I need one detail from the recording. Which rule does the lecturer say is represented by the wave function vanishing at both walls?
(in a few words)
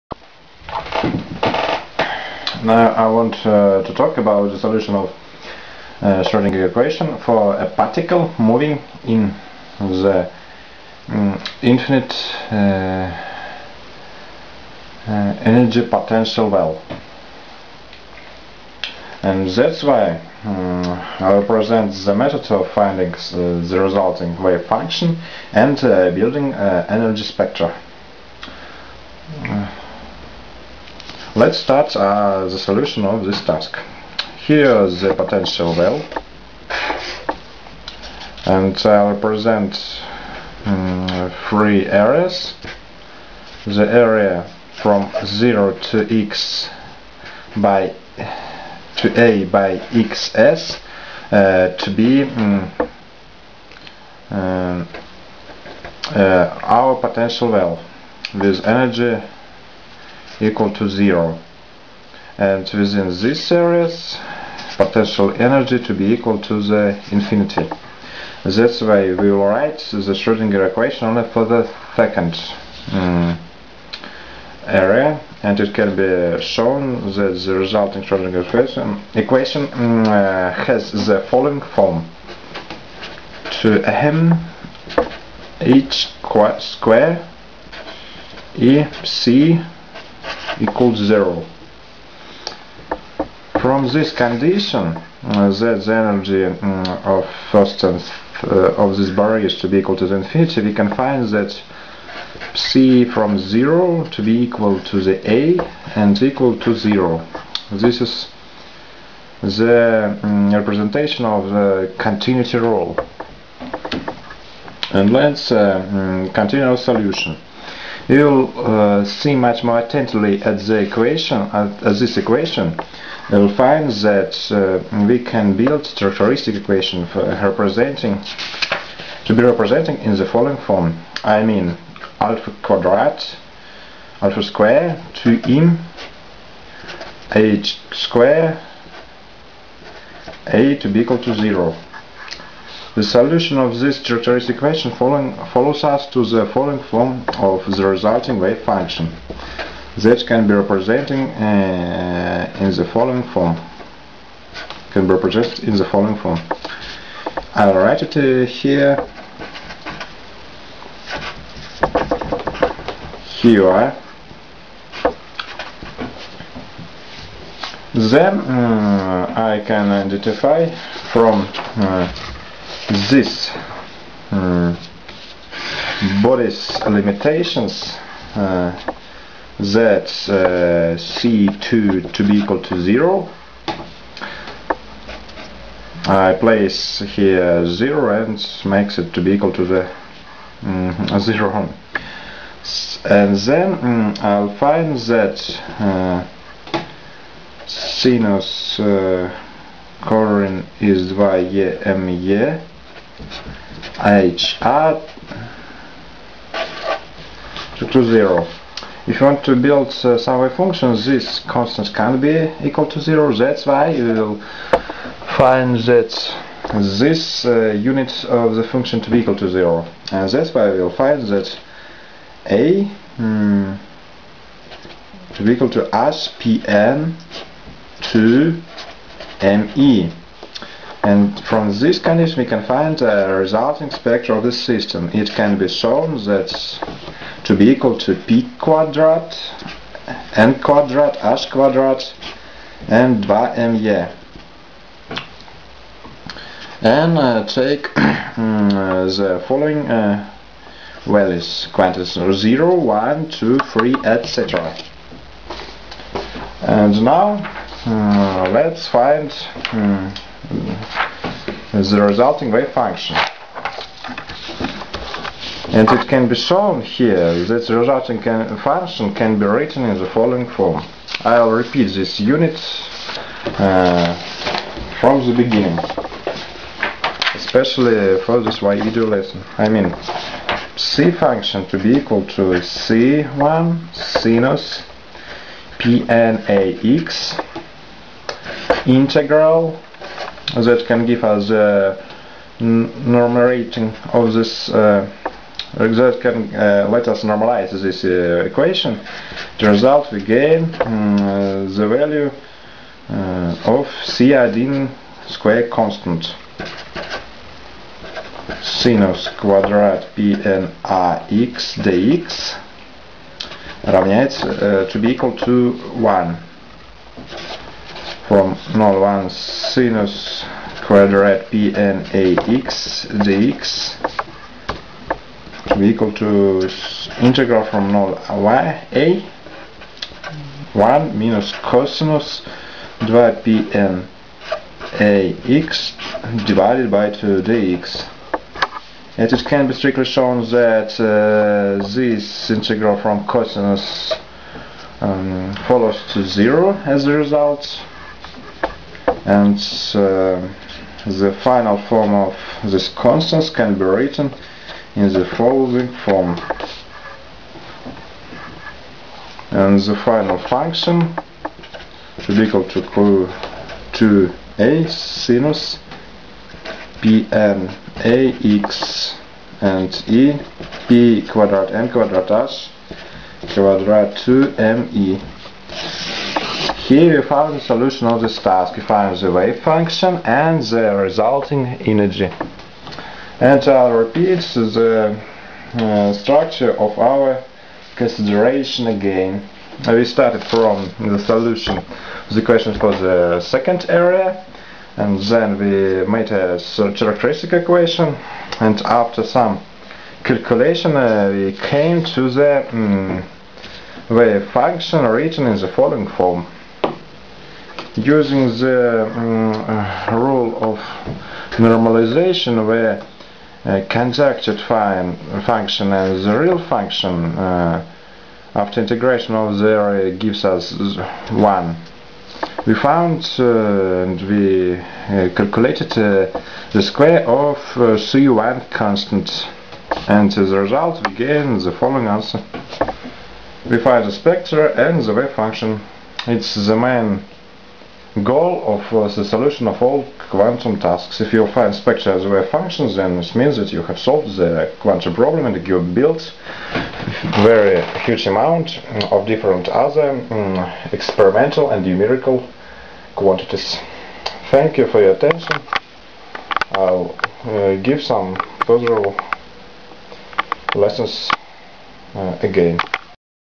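continuity rule.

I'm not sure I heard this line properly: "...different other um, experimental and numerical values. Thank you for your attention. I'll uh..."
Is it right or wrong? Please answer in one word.
wrong.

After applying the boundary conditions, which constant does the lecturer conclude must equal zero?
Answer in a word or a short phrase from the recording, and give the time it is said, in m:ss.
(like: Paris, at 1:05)
C2, at 3:00.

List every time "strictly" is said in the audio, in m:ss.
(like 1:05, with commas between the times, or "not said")
5:39.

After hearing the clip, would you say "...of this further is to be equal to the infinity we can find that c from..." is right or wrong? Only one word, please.
wrong.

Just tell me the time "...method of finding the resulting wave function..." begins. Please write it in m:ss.
0:22.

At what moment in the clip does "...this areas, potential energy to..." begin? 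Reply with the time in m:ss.
1:03.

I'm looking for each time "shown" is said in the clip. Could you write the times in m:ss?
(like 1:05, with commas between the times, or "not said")
1:16, 3:55, 4:26, 5:40.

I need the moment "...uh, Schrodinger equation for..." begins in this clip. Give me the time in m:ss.
0:06.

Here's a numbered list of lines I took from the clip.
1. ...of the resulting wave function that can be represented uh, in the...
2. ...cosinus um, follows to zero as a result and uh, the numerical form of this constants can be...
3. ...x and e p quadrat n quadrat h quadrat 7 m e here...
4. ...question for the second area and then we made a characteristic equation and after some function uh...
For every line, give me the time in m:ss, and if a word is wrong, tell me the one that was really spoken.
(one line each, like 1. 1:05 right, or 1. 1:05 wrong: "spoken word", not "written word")
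1. 2:27 right
2. 5:43 wrong: "final", not "numerical"
3. 6:08 wrong: "2", not "7"
4. 6:32 wrong: "calculation", not "function".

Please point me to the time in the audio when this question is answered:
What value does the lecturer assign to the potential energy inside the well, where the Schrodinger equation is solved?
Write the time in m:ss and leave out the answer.
0:58.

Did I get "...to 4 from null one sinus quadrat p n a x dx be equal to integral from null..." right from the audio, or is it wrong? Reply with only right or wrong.
wrong.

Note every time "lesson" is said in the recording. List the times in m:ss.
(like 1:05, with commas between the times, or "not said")
4:39, 7:40.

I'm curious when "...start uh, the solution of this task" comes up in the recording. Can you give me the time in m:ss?
0:31.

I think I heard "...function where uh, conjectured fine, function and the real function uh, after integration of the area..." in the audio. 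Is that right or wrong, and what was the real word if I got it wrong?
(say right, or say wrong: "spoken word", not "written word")
wrong: "normalization", not "function".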